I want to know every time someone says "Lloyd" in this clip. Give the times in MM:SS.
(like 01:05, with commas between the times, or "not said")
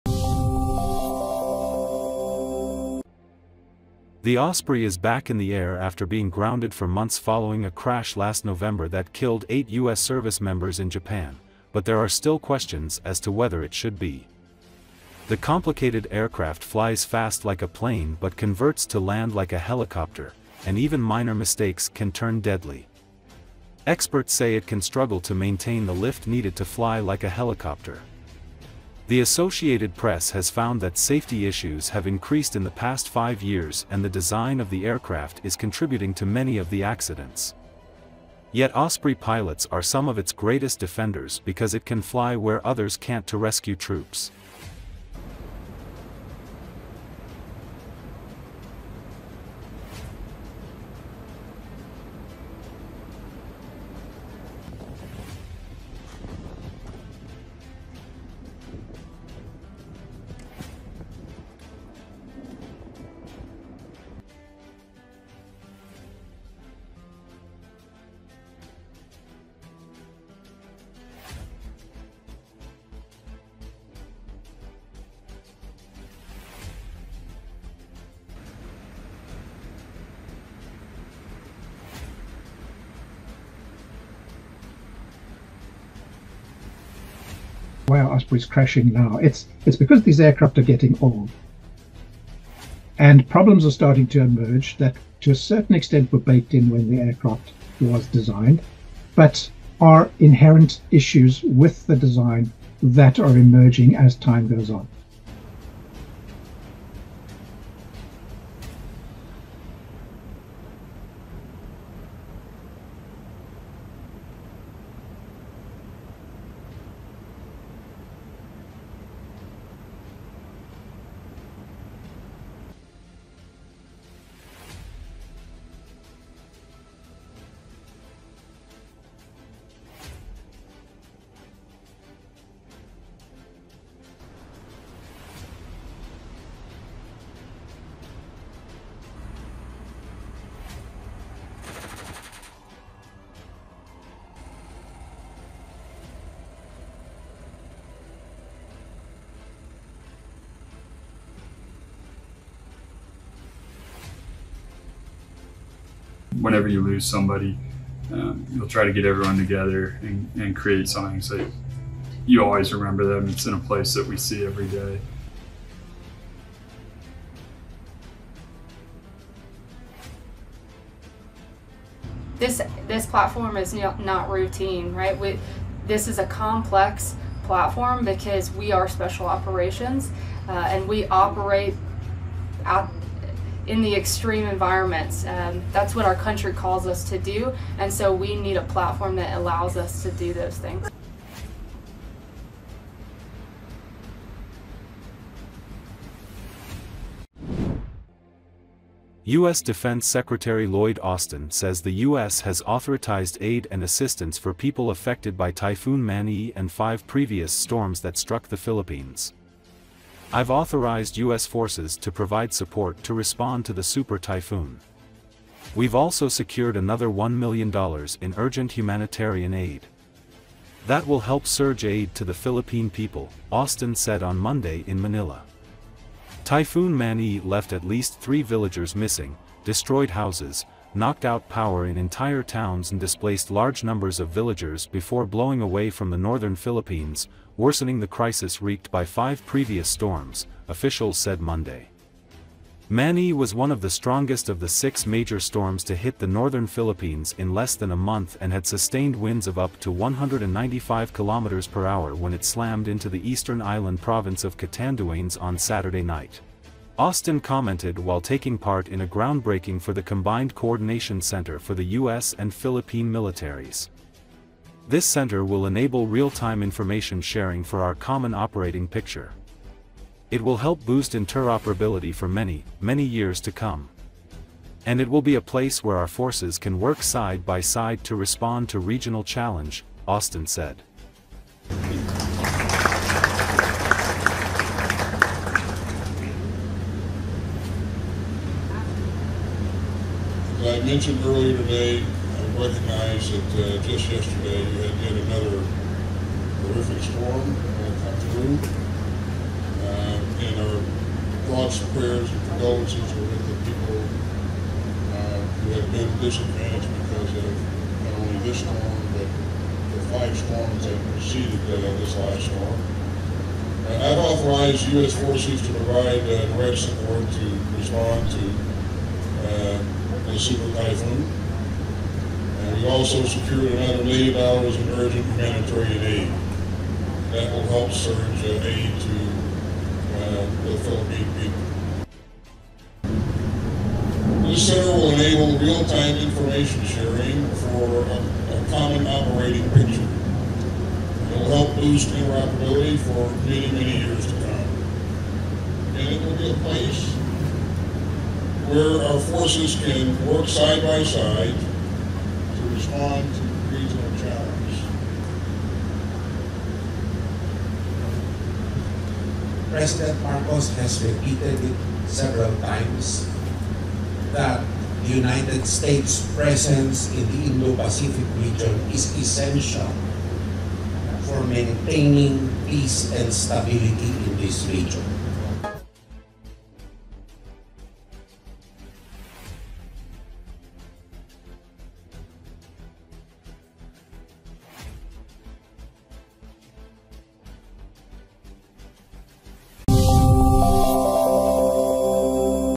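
03:20.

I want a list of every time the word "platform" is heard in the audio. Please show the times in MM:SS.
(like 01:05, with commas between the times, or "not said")
02:53, 02:57, 03:08.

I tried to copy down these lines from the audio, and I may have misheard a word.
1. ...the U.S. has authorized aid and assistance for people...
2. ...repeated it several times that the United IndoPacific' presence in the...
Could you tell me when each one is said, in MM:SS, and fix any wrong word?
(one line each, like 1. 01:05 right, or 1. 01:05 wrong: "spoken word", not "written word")
1. 03:21 right
2. 06:01 wrong: "States", not "IndoPacific".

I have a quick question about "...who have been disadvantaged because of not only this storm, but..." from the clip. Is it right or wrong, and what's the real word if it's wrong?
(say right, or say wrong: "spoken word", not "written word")
right.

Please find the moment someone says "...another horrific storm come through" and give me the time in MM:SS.
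04:55.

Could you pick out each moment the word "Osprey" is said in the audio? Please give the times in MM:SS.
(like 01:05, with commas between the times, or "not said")
00:04, 00:38, 01:28.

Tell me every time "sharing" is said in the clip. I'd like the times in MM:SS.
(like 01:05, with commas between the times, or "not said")
04:27, 05:36.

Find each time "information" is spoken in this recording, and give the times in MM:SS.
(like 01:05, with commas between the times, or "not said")
04:26, 05:36.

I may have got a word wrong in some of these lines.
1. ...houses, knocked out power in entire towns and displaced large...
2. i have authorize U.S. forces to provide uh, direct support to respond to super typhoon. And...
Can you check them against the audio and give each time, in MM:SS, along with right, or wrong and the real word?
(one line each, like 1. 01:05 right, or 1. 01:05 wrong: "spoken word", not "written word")
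1. 03:50 right
2. 05:13 right.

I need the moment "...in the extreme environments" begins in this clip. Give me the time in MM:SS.
03:03.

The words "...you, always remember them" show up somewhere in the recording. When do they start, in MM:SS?
02:42.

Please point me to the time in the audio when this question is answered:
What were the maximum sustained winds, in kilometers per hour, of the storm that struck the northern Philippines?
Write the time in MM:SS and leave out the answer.
04:09.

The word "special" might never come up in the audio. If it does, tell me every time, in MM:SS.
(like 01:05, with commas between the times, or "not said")
02:58.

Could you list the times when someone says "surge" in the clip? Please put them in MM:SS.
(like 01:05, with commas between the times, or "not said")
03:41, 05:27.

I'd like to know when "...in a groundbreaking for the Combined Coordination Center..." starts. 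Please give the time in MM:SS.
04:18.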